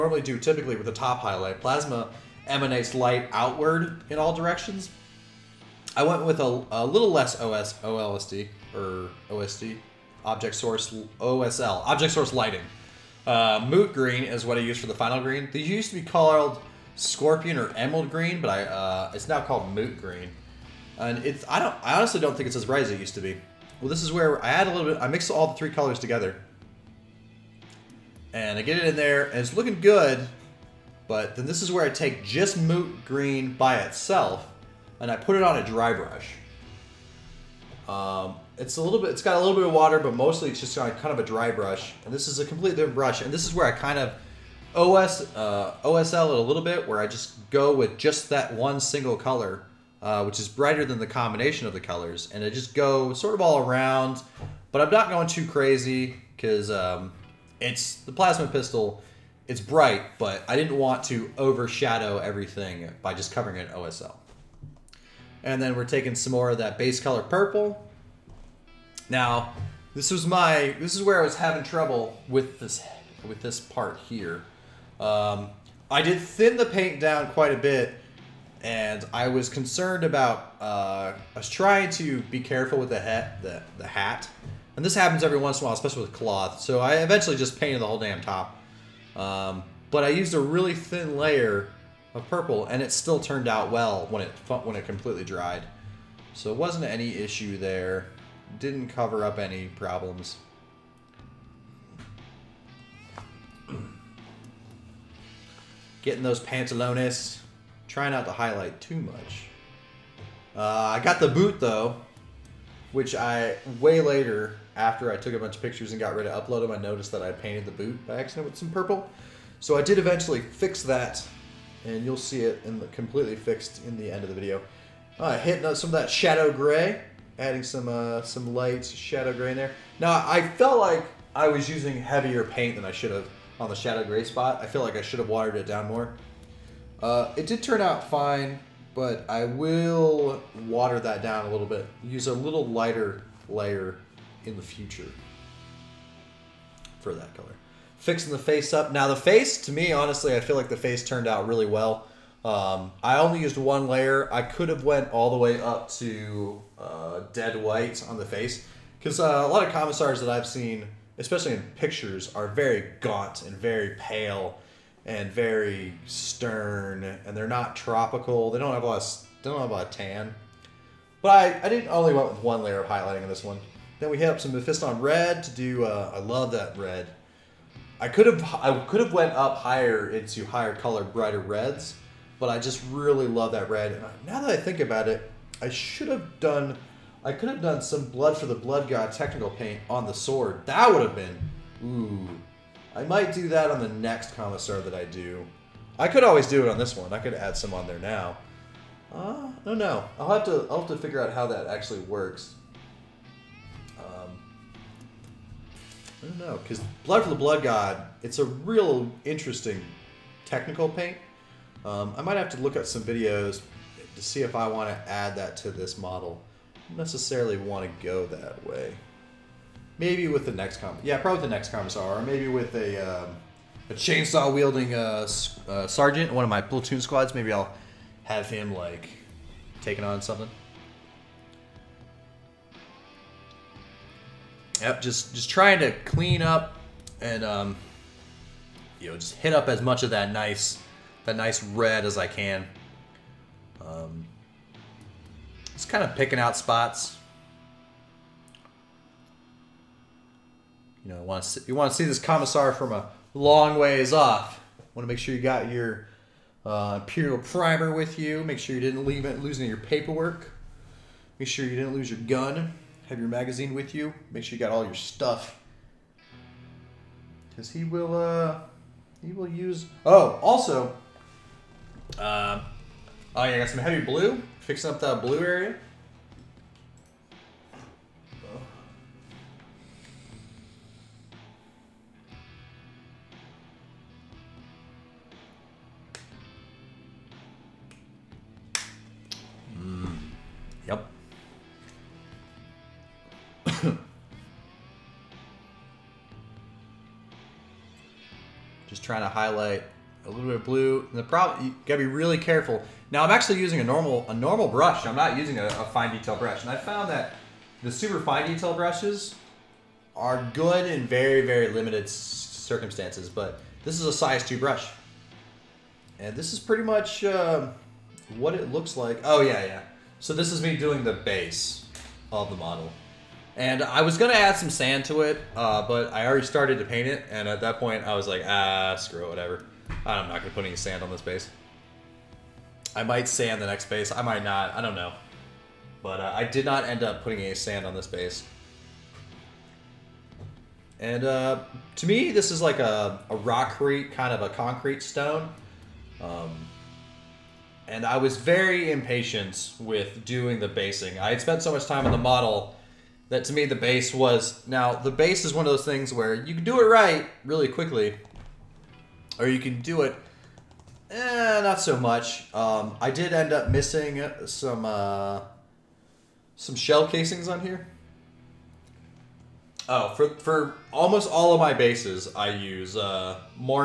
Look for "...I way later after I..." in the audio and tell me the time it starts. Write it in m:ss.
1:53.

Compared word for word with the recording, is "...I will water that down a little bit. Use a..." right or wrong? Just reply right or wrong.
right.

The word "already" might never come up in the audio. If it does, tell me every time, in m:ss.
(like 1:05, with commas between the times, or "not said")
5:26.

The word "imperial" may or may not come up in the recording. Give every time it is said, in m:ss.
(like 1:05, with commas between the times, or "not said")
4:17.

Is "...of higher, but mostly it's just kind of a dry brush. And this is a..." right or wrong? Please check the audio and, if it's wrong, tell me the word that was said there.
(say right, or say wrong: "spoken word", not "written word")
wrong: "water", not "higher".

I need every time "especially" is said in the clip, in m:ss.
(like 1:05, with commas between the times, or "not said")
1:25, 2:41.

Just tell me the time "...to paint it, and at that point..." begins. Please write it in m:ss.
5:26.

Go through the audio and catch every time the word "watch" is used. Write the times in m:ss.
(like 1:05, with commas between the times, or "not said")
not said.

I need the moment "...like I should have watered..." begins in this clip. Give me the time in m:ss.
2:14.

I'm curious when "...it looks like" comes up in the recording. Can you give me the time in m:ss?
5:18.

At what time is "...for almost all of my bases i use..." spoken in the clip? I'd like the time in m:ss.
6:10.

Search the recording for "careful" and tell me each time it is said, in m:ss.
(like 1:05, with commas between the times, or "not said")
1:22, 5:02.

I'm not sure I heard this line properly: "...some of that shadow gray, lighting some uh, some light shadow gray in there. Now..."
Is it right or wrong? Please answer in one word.
wrong.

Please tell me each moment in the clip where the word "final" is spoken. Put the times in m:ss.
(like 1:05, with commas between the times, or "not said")
0:14.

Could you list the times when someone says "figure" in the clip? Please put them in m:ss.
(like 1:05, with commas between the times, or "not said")
3:20.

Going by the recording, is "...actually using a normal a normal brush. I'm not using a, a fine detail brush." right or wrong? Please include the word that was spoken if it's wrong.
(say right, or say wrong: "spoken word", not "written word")
right.